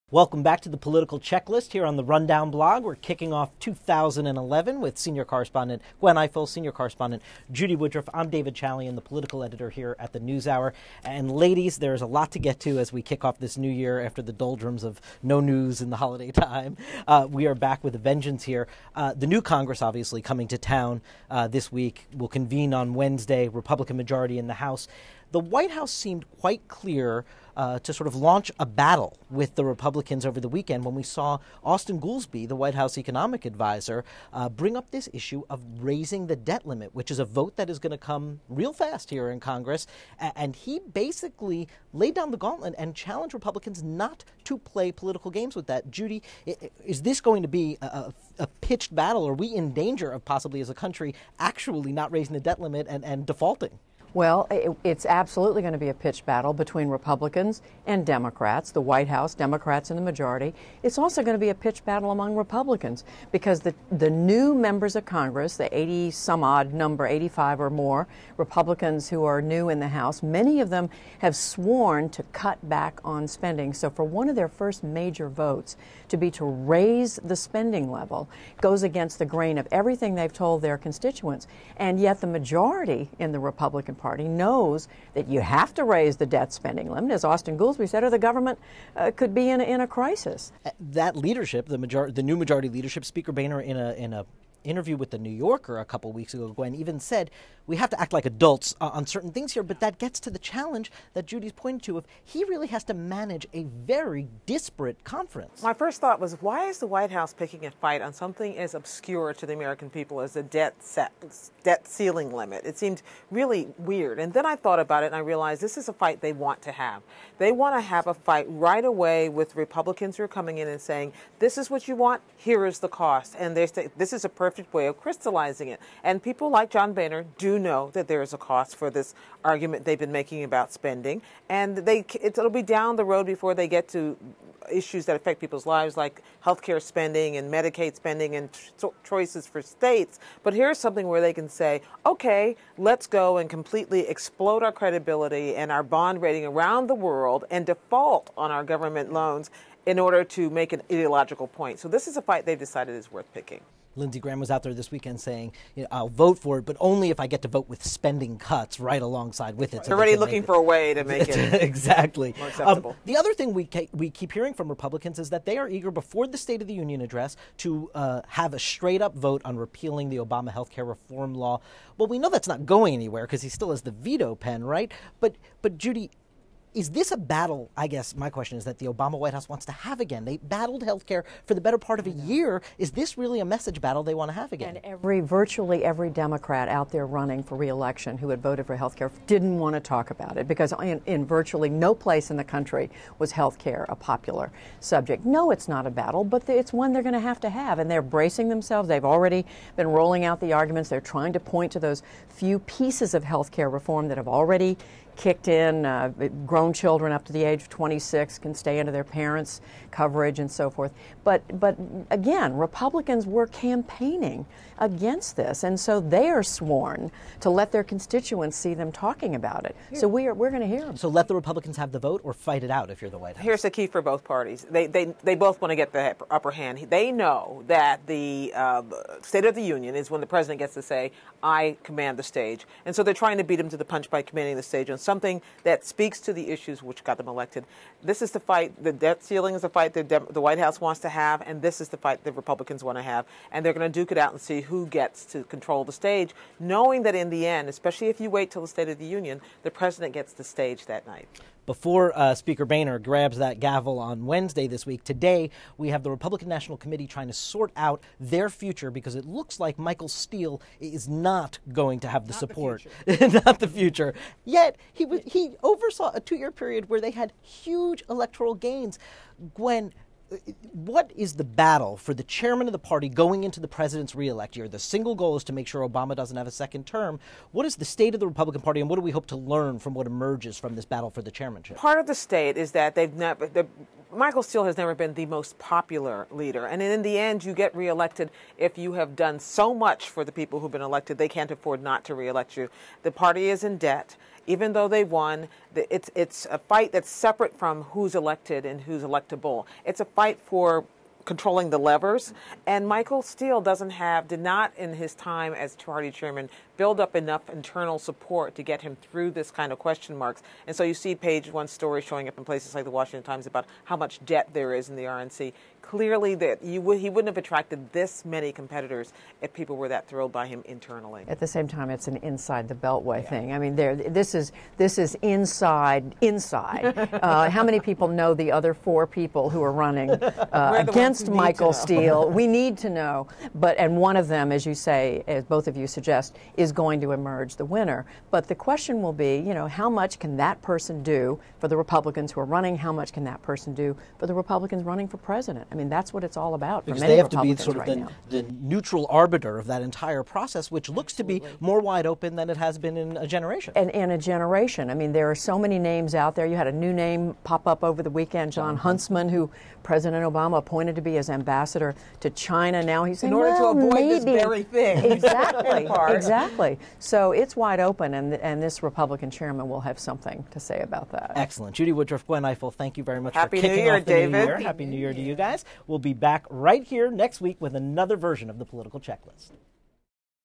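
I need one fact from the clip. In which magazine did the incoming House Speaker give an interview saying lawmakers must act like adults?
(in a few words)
New Yorker.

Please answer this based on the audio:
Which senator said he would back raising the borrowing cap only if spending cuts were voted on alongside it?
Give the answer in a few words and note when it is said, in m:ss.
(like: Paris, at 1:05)
Lindsey Graham, at 2:33.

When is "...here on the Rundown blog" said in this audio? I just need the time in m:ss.
0:01.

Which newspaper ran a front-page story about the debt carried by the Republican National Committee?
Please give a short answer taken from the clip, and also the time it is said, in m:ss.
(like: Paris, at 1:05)
Washington Times, at 5:12.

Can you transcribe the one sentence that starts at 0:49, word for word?
Are we in danger of possibly, as a country, actually not raising the debt limit and, and defaulting?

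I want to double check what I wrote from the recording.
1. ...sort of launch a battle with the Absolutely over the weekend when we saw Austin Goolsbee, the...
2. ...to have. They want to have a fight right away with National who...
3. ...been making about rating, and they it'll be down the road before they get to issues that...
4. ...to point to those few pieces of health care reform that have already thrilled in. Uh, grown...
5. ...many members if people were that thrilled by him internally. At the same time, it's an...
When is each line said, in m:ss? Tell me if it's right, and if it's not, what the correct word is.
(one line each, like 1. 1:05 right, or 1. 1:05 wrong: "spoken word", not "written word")
1. 0:27 wrong: "Republicans", not "Absolutely"
2. 1:56 wrong: "Republicans", not "National"
3. 2:09 wrong: "spending", not "rating"
4. 3:21 wrong: "kicked", not "thrilled"
5. 5:18 wrong: "competitors", not "members".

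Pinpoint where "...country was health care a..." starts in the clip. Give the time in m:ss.
3:12.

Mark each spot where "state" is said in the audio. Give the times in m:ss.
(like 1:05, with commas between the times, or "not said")
2:19, 2:46, 3:49, 4:08, 4:37, 4:42.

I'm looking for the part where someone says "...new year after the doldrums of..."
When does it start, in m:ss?
0:13.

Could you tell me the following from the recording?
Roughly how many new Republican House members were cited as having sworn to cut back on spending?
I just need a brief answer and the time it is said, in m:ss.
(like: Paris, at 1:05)
85, at 1:07.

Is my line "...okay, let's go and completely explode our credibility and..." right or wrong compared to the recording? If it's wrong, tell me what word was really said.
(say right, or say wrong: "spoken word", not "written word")
right.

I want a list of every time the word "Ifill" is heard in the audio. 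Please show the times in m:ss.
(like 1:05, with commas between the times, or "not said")
0:06, 6:12.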